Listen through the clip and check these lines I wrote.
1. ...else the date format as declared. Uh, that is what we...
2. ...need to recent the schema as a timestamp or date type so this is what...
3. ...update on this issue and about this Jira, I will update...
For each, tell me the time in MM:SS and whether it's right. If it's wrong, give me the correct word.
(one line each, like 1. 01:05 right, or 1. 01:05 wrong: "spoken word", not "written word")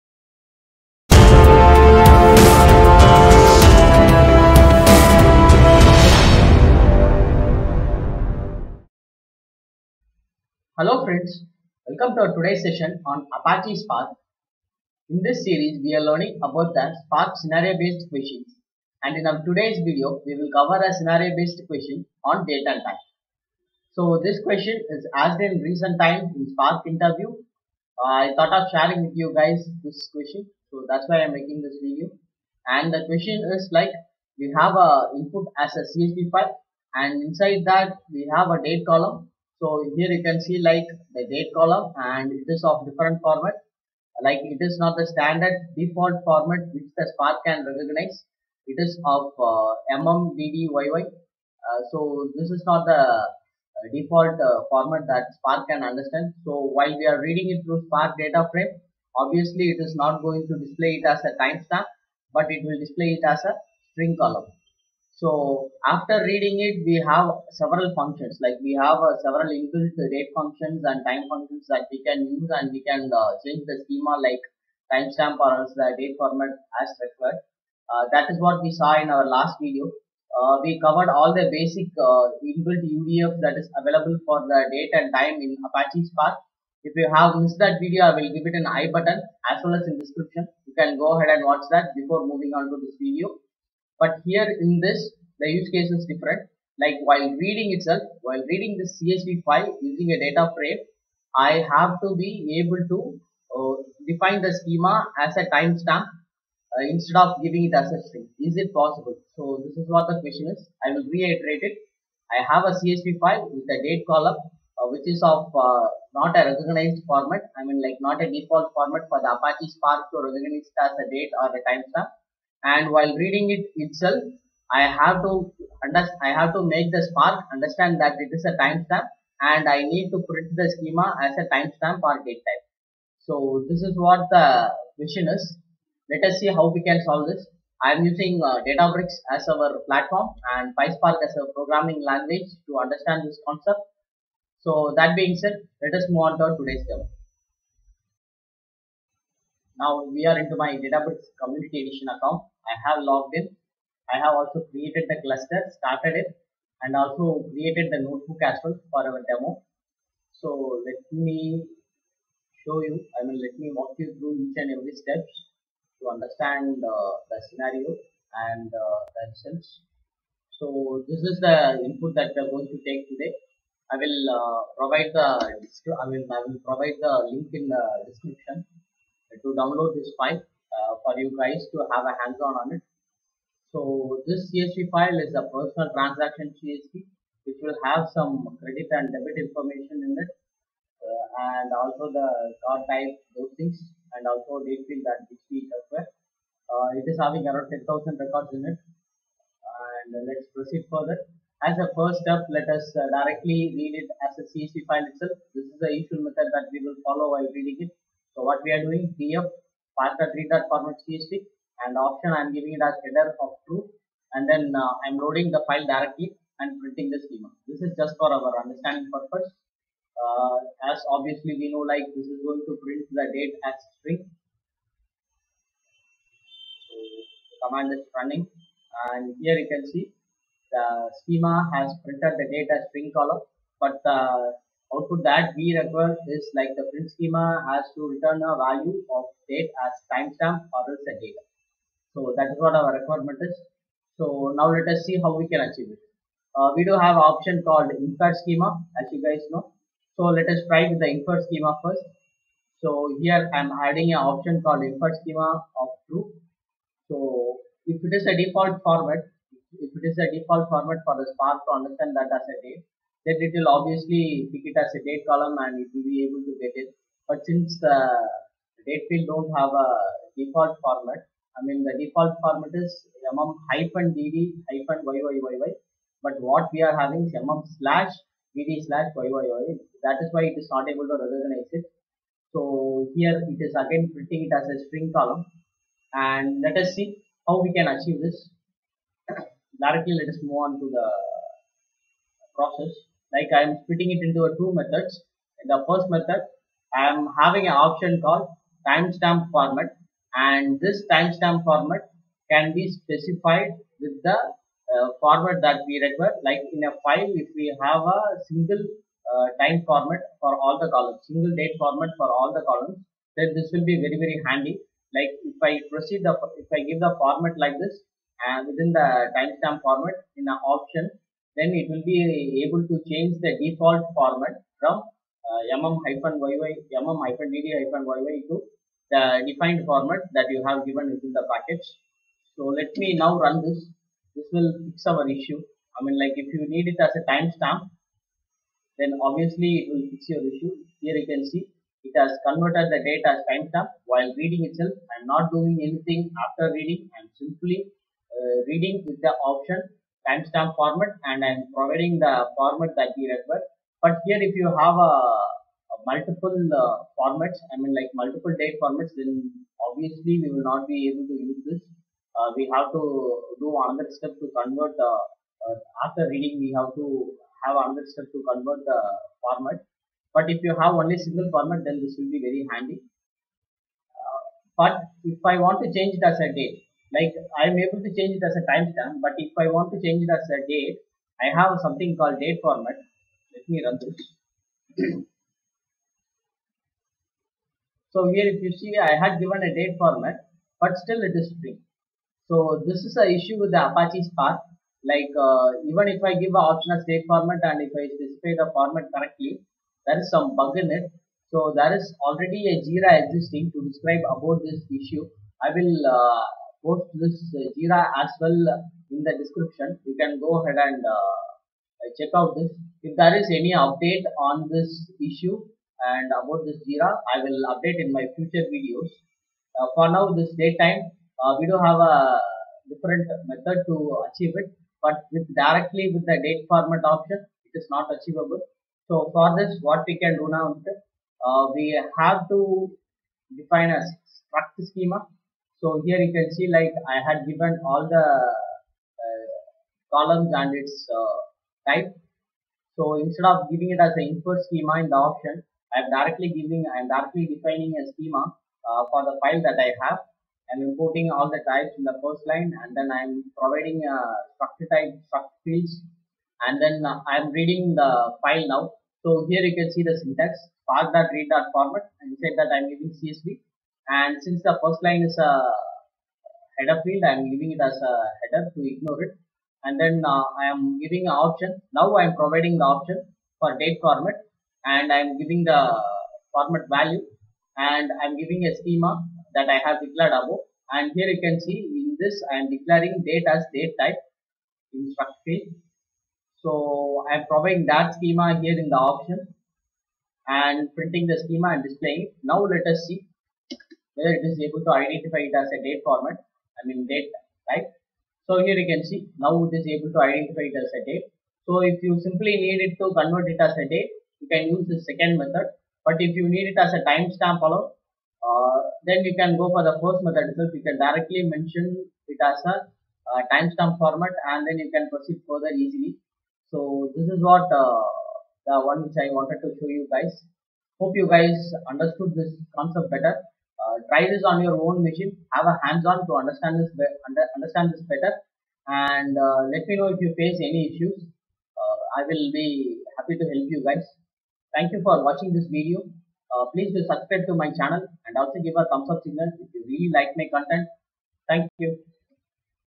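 1. 01:15 wrong: "required", not "declared"
2. 02:09 wrong: "print", not "recent"
3. 06:53 right.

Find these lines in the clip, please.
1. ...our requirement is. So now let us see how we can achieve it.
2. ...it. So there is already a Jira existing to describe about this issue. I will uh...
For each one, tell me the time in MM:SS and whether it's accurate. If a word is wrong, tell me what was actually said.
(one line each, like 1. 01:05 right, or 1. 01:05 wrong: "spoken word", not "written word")
1. 04:02 right
2. 06:40 right.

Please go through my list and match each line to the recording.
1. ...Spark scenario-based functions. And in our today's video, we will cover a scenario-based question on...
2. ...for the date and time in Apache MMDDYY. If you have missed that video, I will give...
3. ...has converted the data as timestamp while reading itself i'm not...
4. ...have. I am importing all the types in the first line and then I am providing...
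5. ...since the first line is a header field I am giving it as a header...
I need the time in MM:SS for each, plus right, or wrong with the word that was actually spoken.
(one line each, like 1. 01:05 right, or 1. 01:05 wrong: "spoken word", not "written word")
1. 00:17 wrong: "questions", not "functions"
2. 01:24 wrong: "Spark", not "MMDDYY"
3. 05:42 right
4. 07:30 right
5. 07:44 right.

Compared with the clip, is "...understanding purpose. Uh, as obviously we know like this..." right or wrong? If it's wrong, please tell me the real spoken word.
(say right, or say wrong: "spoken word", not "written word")
right.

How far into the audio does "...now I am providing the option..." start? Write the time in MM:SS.
07:51.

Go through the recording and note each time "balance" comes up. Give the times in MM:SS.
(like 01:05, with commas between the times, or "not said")
not said.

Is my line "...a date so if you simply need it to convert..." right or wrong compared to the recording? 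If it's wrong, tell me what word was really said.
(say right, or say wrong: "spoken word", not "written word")
right.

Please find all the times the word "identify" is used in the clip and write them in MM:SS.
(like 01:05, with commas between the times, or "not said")
08:14, 08:20.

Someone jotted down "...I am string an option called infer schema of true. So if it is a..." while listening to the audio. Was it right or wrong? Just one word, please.
wrong.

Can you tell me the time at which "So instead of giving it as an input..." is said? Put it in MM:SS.
07:22.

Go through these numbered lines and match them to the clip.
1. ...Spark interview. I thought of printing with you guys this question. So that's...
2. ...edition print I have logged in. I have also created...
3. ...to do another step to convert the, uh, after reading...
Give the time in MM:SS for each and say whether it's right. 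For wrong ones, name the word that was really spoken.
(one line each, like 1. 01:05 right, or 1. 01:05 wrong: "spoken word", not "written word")
1. 00:26 wrong: "sharing", not "printing"
2. 02:31 wrong: "account", not "print"
3. 06:02 right.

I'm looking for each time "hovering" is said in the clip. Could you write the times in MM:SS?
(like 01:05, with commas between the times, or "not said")
not said.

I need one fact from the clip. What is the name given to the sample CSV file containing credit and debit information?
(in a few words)
personal transaction CSV.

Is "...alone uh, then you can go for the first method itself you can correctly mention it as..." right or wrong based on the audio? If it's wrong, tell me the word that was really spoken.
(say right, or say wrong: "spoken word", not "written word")
wrong: "directly", not "correctly".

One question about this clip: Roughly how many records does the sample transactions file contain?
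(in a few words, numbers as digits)
10,000.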